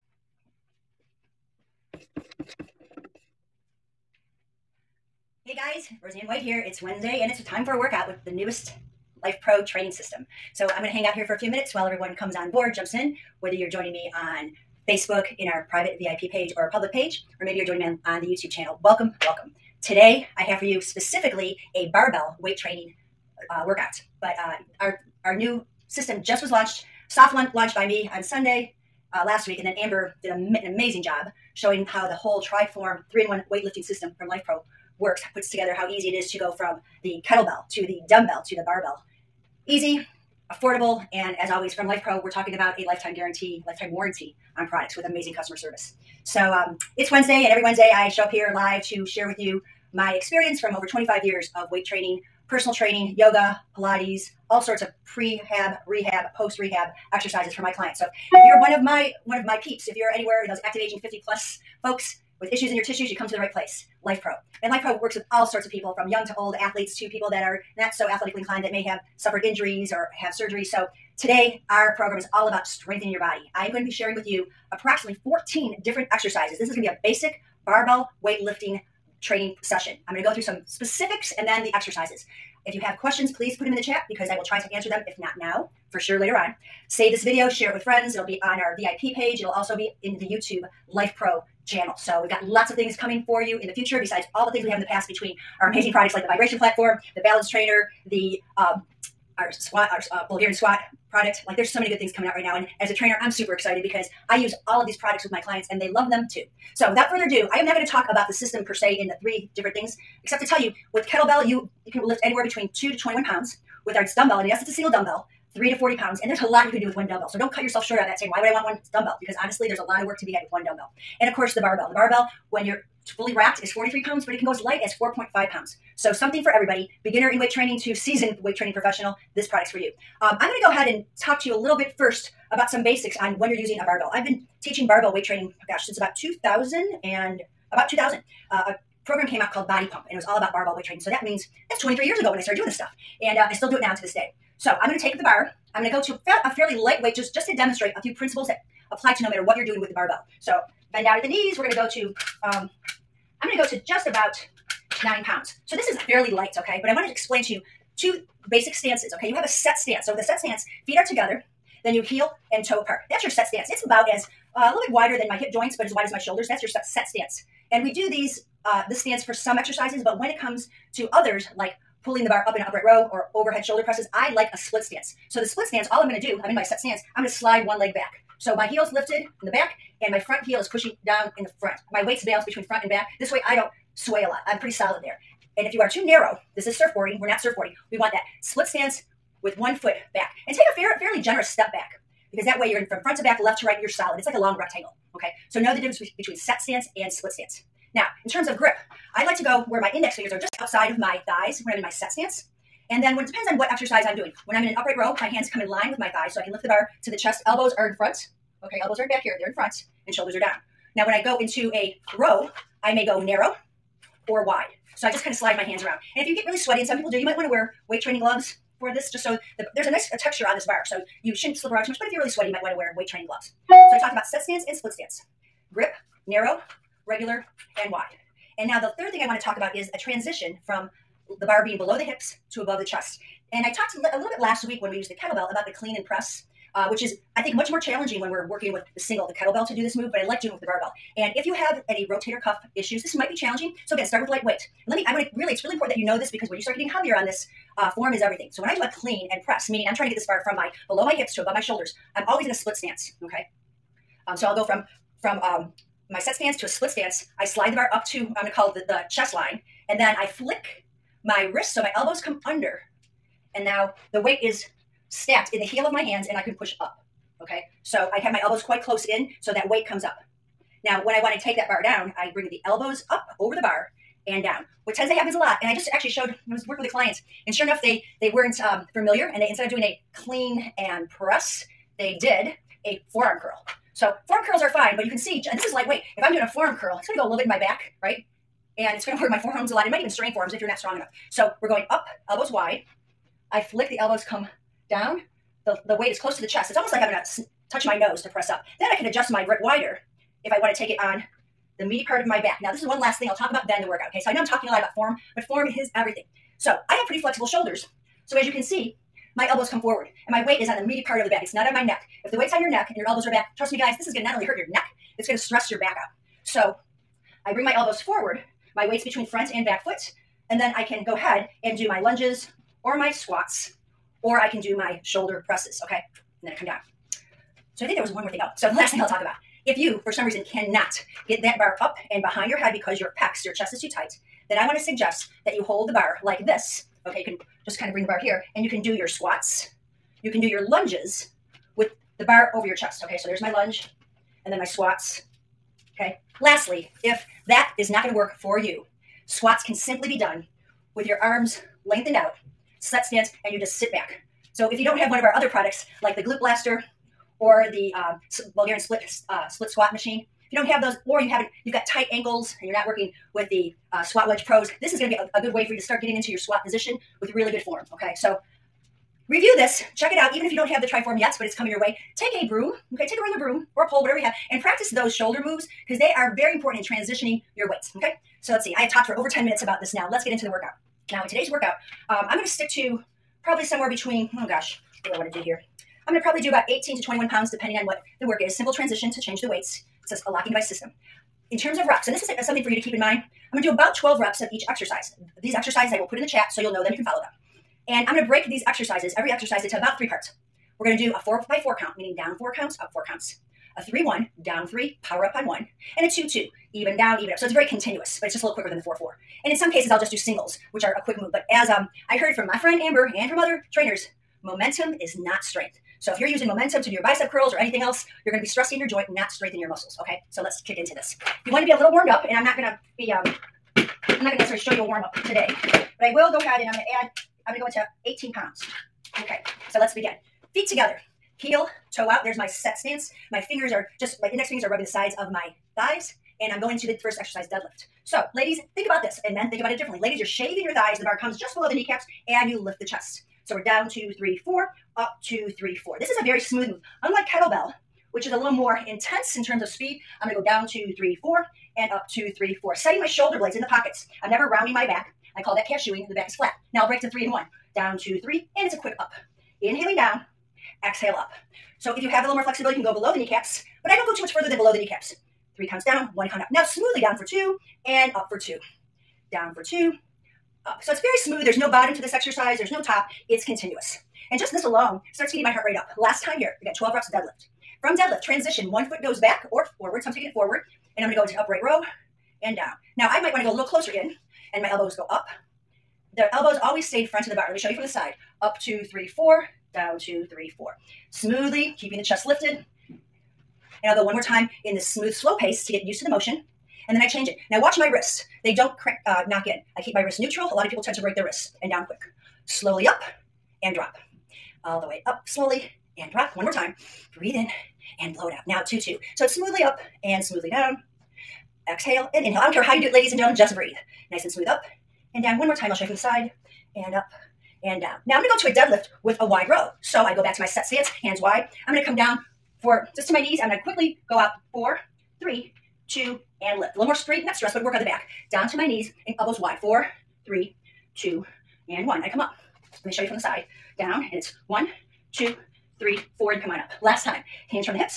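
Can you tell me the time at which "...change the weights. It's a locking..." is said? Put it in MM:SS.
06:29.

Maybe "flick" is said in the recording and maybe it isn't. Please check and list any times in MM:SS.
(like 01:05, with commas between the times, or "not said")
04:20, 04:53.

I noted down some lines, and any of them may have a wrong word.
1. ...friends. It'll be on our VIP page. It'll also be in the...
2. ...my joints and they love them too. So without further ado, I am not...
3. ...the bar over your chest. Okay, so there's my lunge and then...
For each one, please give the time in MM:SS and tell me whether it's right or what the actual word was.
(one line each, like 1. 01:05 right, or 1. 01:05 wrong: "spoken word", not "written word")
1. 01:27 right
2. 01:45 wrong: "clients", not "joints"
3. 05:42 right.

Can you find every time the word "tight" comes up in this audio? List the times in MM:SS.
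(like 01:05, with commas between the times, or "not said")
05:33, 06:01.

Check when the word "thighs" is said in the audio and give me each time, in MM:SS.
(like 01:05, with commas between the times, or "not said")
03:21, 03:26, 07:15, 07:20.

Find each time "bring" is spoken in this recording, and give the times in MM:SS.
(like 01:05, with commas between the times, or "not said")
04:32, 05:17, 05:37.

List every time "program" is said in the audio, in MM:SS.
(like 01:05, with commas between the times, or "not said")
01:11, 02:19.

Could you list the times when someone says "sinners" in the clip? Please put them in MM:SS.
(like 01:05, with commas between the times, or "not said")
not said.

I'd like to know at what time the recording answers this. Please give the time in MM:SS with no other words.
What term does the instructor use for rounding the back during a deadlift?
07:35.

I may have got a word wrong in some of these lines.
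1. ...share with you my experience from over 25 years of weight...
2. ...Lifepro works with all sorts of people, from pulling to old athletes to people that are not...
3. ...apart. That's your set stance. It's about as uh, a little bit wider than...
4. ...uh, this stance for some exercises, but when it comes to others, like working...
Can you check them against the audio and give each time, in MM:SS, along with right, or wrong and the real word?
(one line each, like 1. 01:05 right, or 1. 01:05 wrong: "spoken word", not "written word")
1. 00:49 right
2. 01:04 wrong: "young", not "pulling"
3. 02:42 right
4. 02:48 wrong: "pulling", not "working".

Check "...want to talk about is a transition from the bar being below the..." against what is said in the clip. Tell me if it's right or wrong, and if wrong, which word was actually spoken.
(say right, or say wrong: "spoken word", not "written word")
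right.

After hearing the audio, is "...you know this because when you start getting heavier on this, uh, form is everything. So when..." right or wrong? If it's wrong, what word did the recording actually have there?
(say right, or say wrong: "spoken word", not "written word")
right.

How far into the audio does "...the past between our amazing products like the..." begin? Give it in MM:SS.
01:34.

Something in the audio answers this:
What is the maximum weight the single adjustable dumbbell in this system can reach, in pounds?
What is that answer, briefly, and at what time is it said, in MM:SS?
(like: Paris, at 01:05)
40, at 01:55.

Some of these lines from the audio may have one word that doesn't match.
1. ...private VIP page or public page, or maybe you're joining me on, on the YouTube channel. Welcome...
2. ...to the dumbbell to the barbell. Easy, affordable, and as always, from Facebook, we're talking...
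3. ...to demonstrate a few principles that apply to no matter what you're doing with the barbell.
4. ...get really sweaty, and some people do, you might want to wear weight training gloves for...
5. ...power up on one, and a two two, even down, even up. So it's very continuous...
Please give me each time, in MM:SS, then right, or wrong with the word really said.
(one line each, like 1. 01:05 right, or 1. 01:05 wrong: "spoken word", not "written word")
1. 00:15 right
2. 00:37 wrong: "Lifepro", not "Facebook"
3. 02:27 right
4. 03:36 right
5. 06:45 right.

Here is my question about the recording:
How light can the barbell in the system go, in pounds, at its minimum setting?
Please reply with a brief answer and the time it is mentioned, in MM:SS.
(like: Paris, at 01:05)
4.5, at 02:04.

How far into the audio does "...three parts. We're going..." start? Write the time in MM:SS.
06:39.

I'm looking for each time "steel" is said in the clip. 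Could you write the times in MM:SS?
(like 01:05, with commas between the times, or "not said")
not said.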